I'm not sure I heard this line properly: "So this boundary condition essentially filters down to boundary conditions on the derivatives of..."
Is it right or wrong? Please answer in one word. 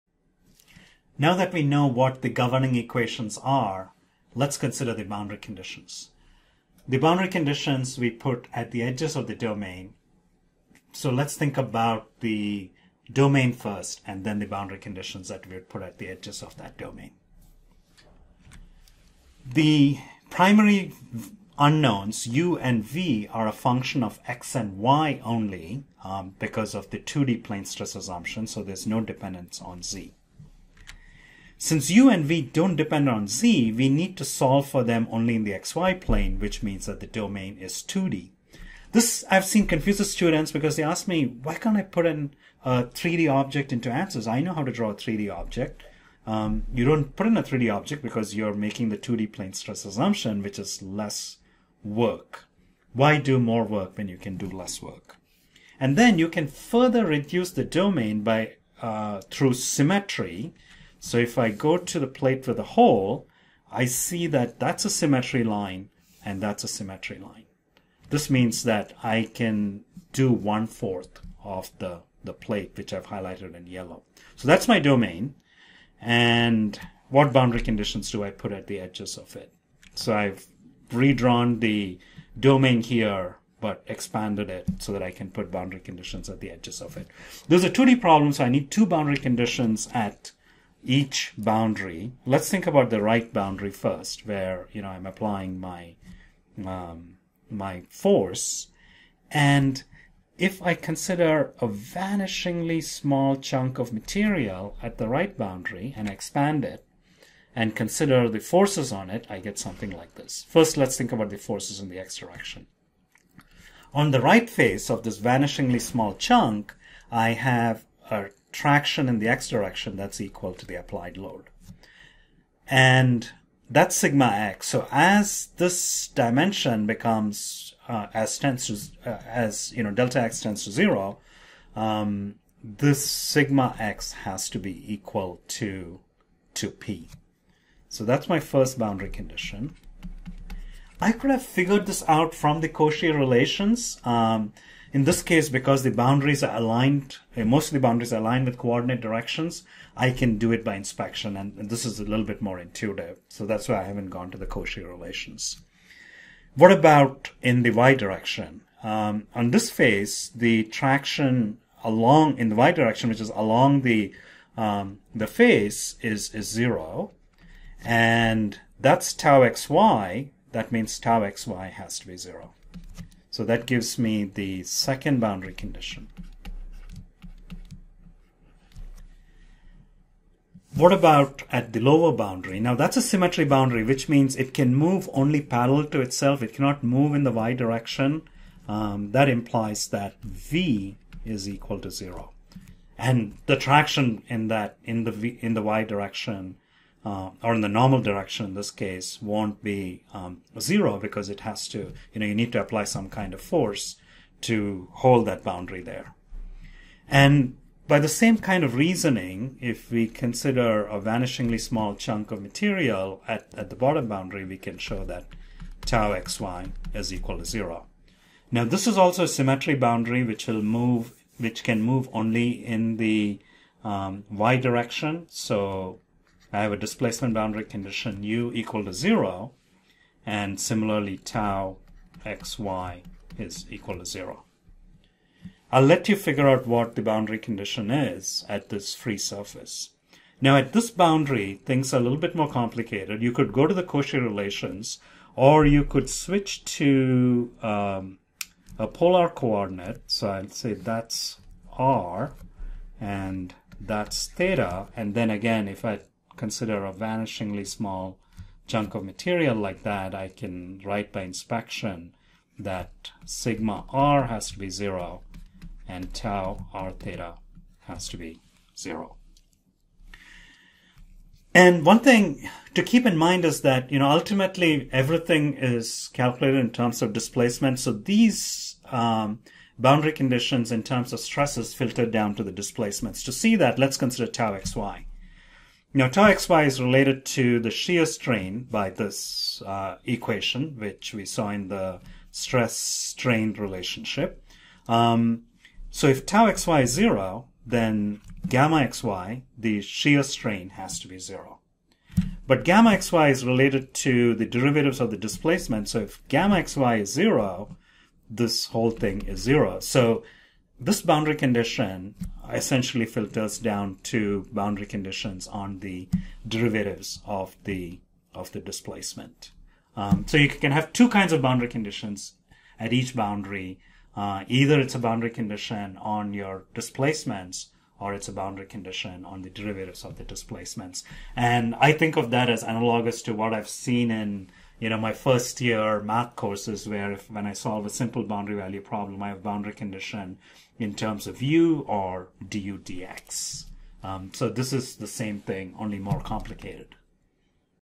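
right.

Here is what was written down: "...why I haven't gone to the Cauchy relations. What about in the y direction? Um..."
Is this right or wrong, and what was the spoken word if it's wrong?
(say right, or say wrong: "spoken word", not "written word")
right.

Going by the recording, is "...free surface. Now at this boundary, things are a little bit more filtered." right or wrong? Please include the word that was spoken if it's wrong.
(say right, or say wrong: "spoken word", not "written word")
wrong: "complicated", not "filtered".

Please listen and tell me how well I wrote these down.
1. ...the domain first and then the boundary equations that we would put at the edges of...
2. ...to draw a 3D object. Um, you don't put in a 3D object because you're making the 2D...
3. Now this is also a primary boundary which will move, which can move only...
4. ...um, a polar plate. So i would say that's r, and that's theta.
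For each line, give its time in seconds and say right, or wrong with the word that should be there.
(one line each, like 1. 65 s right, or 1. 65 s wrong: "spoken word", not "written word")
1. 12 s wrong: "conditions", not "equations"
2. 44 s right
3. 218 s wrong: "symmetry", not "primary"
4. 247 s wrong: "coordinate", not "plate".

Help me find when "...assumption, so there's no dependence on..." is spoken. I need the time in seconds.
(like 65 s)
27 s.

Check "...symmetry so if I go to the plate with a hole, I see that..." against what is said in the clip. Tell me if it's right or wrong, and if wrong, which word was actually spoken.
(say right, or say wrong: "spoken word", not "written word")
right.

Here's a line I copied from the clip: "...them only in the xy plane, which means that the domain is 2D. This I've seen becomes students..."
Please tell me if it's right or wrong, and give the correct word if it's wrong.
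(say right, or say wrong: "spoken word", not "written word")
wrong: "confuses", not "becomes".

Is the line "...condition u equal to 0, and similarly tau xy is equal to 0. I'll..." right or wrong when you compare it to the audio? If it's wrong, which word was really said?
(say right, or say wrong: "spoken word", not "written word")
right.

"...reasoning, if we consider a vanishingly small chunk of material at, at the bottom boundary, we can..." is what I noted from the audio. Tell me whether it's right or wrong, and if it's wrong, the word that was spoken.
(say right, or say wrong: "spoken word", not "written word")
right.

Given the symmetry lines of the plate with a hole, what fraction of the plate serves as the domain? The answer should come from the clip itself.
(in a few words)
one fourth.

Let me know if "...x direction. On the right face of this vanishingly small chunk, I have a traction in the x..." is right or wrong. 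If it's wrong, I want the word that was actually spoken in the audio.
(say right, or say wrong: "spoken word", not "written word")
right.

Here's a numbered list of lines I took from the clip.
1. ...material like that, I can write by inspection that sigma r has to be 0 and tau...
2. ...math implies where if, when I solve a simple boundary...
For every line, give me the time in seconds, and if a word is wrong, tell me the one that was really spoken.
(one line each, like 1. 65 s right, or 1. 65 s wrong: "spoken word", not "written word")
1. 259 s right
2. 336 s wrong: "courses", not "implies".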